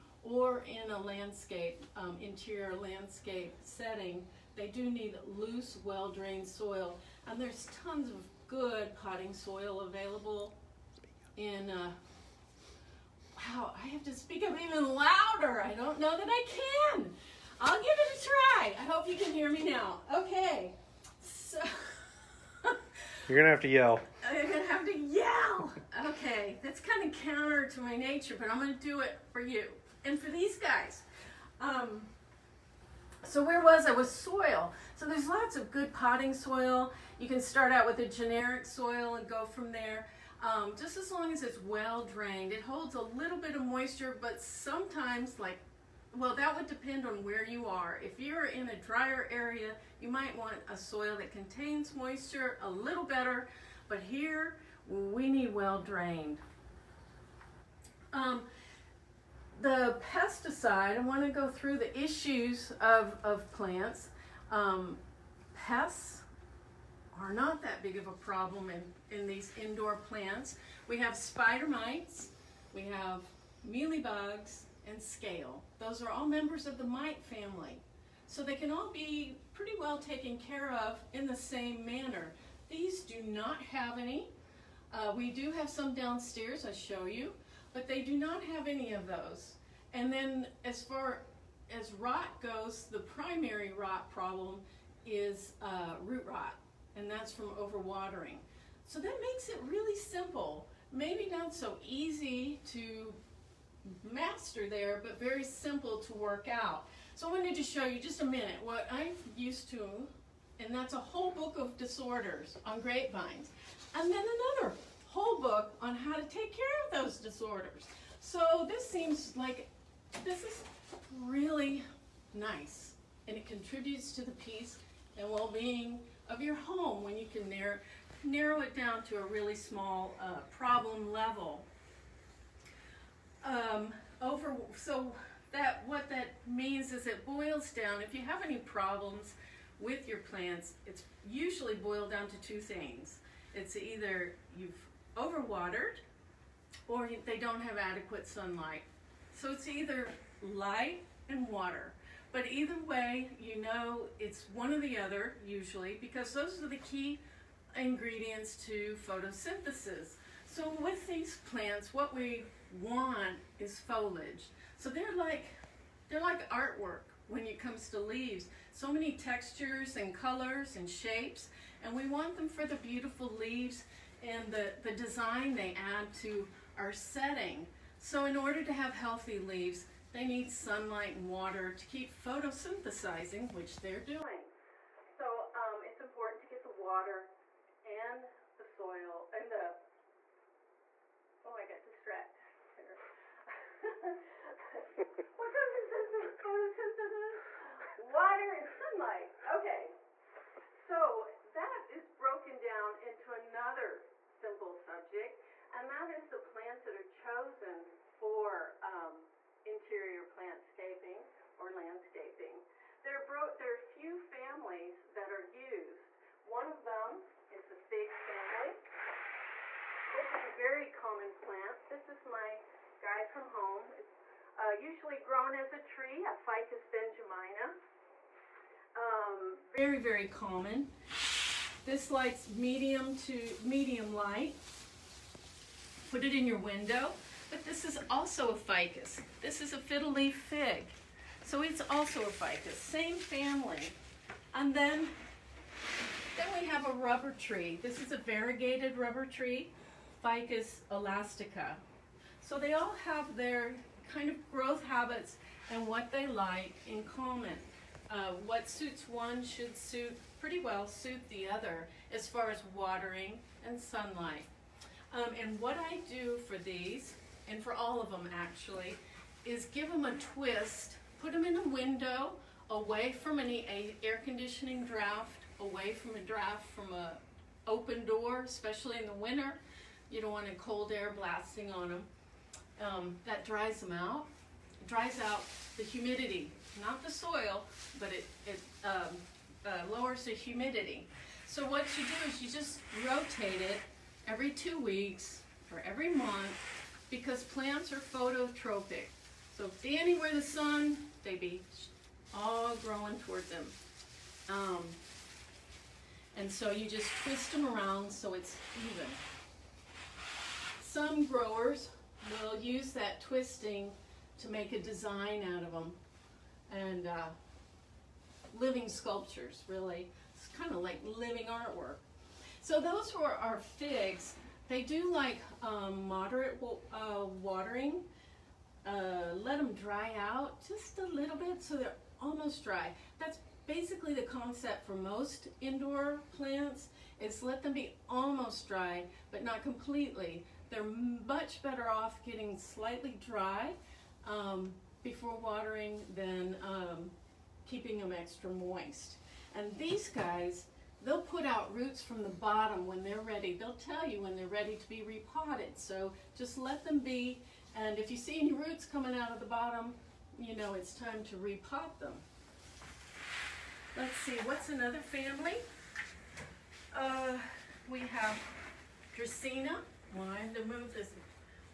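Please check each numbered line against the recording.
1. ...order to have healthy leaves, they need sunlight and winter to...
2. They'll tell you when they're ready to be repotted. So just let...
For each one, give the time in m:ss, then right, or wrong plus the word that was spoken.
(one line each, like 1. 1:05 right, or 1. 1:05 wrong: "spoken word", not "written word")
1. 2:58 wrong: "water", not "winter"
2. 5:53 right.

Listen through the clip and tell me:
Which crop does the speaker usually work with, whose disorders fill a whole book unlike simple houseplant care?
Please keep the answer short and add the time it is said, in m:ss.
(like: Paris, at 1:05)
grapevines, at 1:52.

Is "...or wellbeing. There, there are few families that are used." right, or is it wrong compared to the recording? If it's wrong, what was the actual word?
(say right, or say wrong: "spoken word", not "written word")
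wrong: "landscaping", not "wellbeing".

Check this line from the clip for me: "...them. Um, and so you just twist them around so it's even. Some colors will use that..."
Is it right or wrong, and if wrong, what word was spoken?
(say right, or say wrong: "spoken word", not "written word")
wrong: "growers", not "colors".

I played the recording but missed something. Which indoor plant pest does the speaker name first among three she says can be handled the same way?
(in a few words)
spider mites.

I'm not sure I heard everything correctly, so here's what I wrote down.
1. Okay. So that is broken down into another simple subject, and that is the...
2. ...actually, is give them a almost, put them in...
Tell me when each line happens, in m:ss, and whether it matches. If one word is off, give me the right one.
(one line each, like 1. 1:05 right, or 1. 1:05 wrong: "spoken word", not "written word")
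1. 3:19 right
2. 4:28 wrong: "twist", not "almost".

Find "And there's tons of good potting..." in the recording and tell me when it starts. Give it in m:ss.
0:07.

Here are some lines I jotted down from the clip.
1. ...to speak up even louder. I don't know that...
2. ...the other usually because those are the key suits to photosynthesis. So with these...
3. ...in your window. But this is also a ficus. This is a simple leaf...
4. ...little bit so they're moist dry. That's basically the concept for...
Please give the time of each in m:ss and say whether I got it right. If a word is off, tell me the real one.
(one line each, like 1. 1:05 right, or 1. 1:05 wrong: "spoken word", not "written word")
1. 0:14 right
2. 2:34 wrong: "ingredients", not "suits"
3. 3:56 wrong: "fiddle", not "simple"
4. 5:31 wrong: "almost", not "moist".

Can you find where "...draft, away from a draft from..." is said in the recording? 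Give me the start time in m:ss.
4:34.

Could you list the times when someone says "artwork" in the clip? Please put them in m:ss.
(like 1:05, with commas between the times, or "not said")
2:46, 5:21.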